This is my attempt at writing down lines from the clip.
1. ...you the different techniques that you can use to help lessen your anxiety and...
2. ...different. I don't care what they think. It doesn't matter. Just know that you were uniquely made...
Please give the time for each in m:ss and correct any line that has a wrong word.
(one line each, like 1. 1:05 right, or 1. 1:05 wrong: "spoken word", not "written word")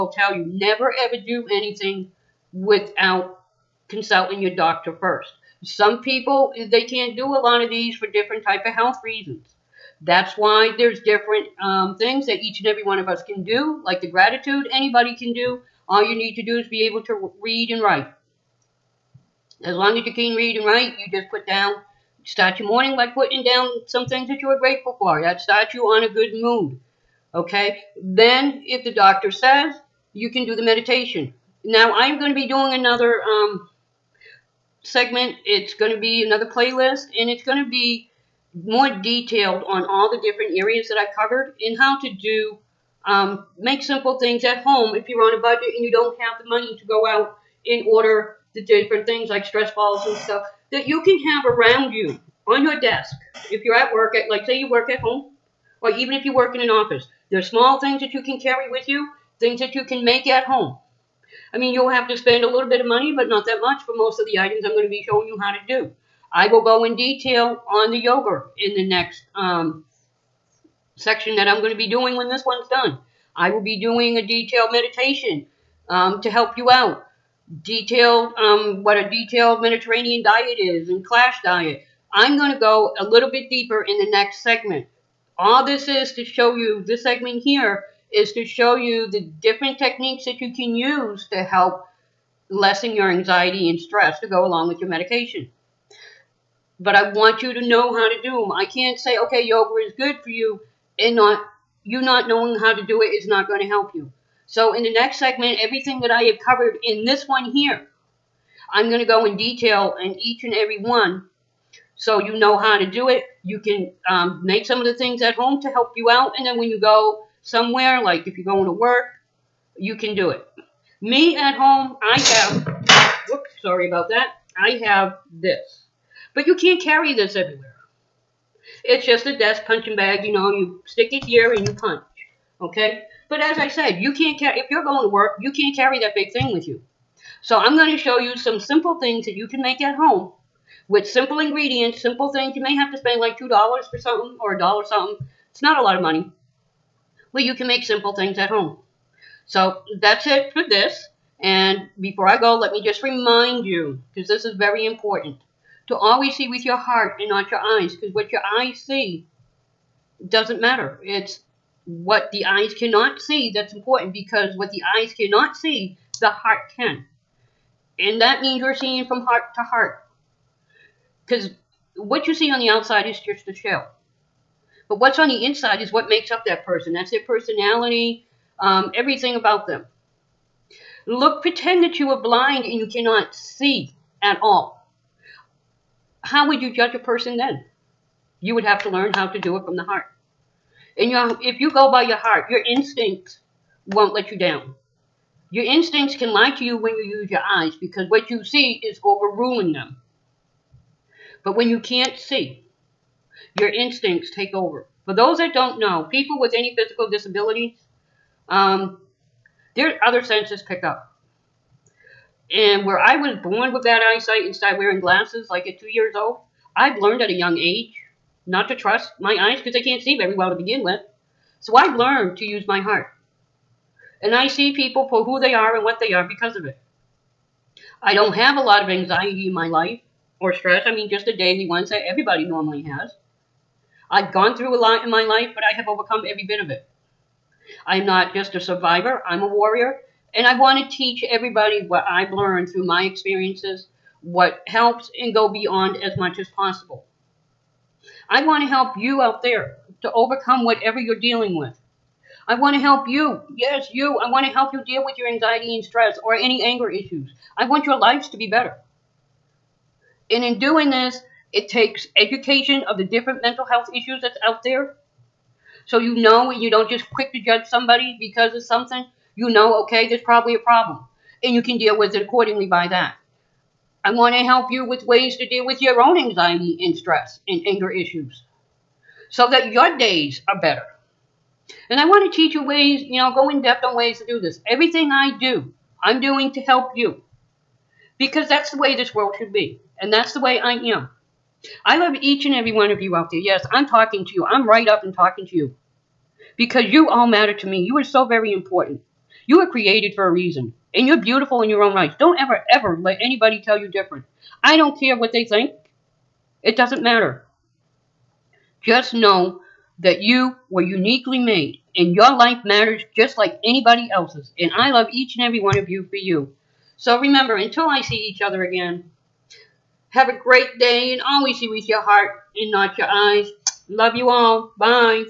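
1. 1:28 right
2. 5:03 right.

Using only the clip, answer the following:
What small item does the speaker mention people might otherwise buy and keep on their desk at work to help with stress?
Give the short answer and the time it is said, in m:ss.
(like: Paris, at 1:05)
stress balls, at 0:49.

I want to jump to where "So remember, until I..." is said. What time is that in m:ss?
5:16.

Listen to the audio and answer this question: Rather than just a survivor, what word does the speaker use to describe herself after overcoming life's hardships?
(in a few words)
warrior.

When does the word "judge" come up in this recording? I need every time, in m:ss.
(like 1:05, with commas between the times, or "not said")
3:06, 4:27.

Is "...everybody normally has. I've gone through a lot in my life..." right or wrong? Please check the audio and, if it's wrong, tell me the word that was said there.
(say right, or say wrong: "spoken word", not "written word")
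right.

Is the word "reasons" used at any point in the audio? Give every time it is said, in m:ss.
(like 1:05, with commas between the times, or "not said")
0:09, 5:00.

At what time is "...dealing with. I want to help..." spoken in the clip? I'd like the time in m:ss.
4:11.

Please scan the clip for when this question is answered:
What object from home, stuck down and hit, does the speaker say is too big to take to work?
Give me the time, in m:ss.
2:09.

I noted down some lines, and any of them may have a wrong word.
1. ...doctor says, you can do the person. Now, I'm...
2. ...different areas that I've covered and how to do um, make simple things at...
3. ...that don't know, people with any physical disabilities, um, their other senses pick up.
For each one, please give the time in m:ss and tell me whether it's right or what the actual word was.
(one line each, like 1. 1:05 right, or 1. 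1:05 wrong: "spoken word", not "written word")
1. 0:28 wrong: "meditation", not "person"
2. 0:40 right
3. 3:25 right.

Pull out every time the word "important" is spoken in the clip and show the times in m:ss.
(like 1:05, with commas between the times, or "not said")
2:34, 2:43, 4:58.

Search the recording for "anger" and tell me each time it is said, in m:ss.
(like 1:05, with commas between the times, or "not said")
4:16, 4:37.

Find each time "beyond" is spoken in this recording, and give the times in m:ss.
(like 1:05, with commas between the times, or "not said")
4:05.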